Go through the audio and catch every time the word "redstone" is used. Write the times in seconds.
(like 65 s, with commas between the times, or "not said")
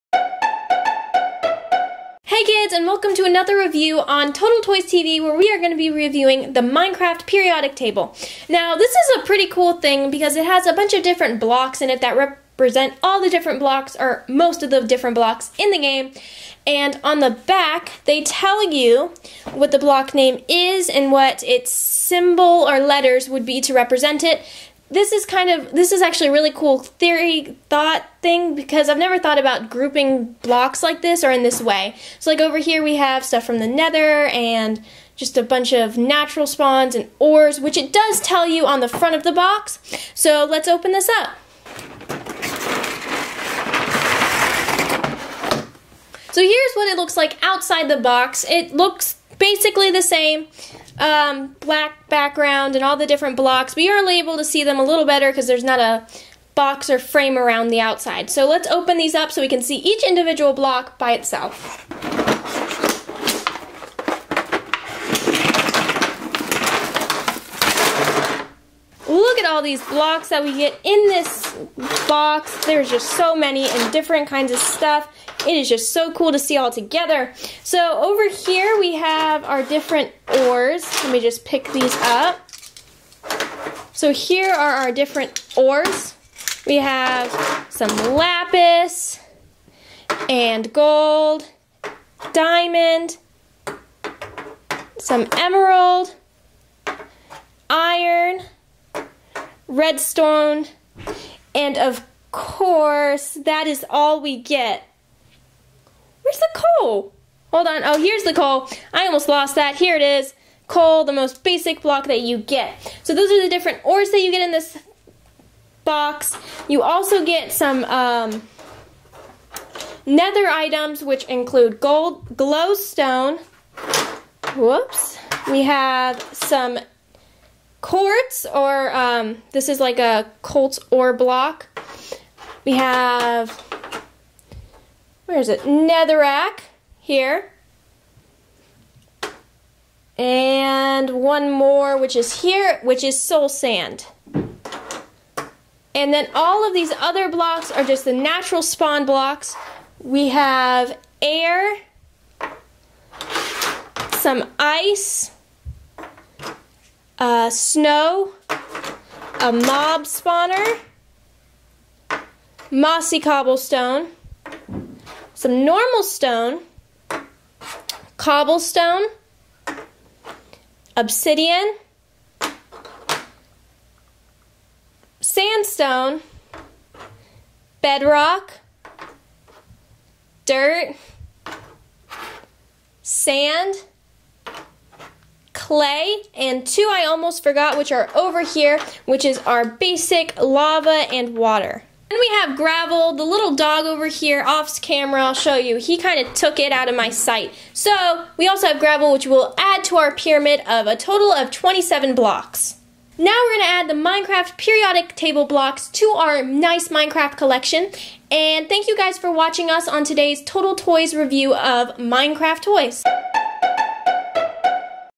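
99 s.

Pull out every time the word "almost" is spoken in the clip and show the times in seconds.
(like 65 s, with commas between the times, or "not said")
109 s, 187 s.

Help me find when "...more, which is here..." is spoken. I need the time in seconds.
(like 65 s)
141 s.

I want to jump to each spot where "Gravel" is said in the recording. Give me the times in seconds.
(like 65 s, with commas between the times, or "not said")
192 s, 198 s.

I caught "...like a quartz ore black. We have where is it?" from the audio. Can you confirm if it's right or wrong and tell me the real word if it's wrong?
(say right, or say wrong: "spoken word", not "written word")
wrong: "block", not "black".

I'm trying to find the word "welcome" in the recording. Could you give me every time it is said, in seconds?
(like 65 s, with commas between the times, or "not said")
2 s.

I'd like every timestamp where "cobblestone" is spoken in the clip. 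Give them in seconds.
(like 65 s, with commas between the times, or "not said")
163 s, 168 s.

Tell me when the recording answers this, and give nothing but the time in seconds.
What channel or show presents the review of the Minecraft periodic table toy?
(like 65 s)
4 s.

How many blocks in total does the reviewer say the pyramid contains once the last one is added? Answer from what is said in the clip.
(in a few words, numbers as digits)
27.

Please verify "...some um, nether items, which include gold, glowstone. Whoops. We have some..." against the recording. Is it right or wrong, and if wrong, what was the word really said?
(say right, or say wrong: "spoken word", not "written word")
right.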